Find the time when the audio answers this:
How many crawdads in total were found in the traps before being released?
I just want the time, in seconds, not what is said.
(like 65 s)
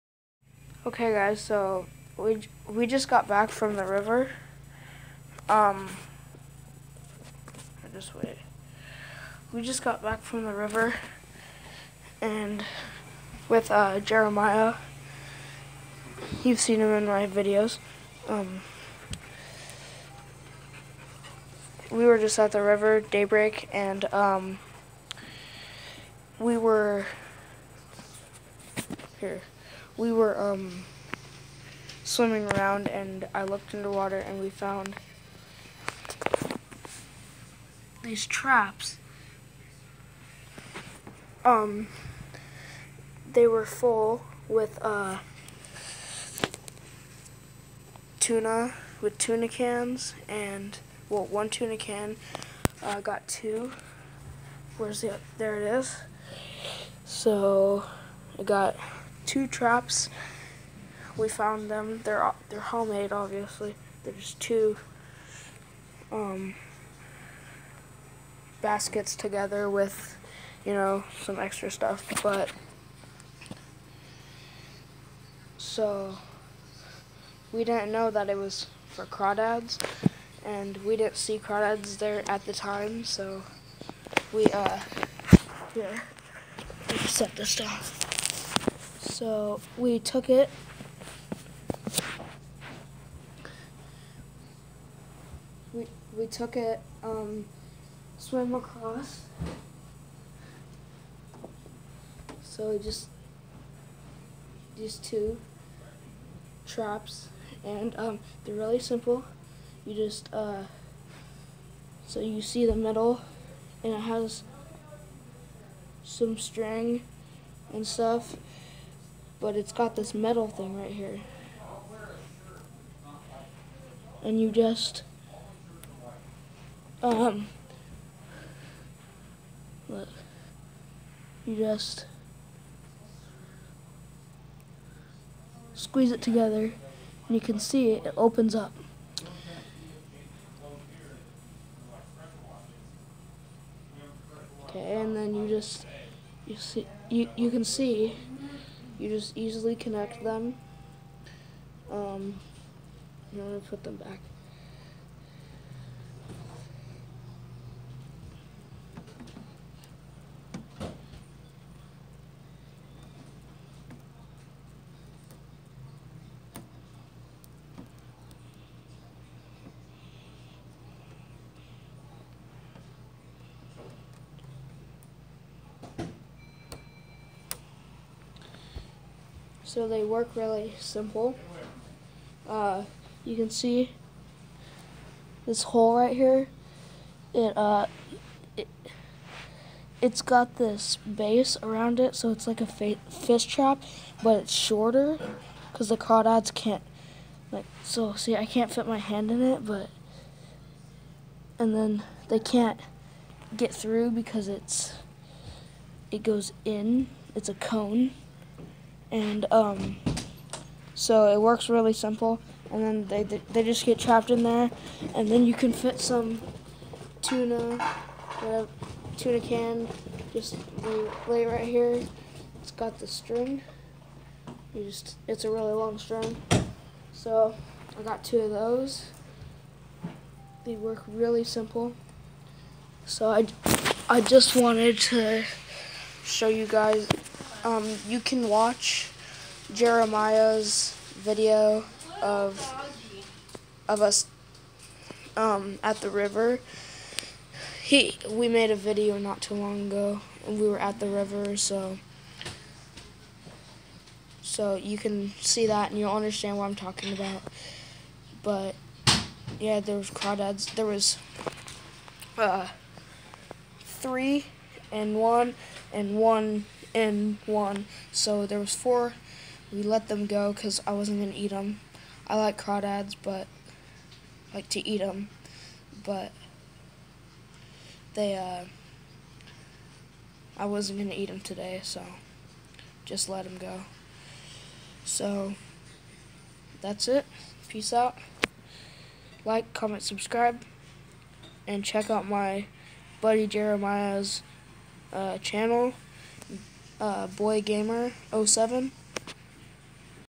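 268 s.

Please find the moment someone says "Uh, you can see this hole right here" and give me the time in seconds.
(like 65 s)
182 s.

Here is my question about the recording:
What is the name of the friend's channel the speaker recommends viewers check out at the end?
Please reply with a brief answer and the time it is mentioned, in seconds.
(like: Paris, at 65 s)
Boy Gamer 07, at 297 s.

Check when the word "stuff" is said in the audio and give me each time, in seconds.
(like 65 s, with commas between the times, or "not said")
71 s, 117 s.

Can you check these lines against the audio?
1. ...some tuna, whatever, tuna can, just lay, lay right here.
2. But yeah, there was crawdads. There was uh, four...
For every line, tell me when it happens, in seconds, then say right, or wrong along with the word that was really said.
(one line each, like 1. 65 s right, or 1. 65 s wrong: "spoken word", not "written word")
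1. 215 s right
2. 258 s wrong: "three", not "four".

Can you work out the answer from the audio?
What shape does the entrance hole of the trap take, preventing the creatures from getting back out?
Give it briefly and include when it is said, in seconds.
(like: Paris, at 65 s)
A cone, at 207 s.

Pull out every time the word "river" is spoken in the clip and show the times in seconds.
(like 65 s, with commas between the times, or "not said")
3 s, 10 s, 22 s, 246 s, 251 s.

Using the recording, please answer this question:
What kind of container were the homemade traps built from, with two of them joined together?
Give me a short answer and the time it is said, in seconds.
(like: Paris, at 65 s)
Baskets, at 68 s.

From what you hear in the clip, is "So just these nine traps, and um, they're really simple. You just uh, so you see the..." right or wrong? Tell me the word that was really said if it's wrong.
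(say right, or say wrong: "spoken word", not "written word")
wrong: "two", not "nine".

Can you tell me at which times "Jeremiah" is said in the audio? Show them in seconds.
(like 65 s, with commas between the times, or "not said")
13 s, 239 s, 293 s.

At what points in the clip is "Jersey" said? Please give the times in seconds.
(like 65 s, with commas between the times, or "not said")
not said.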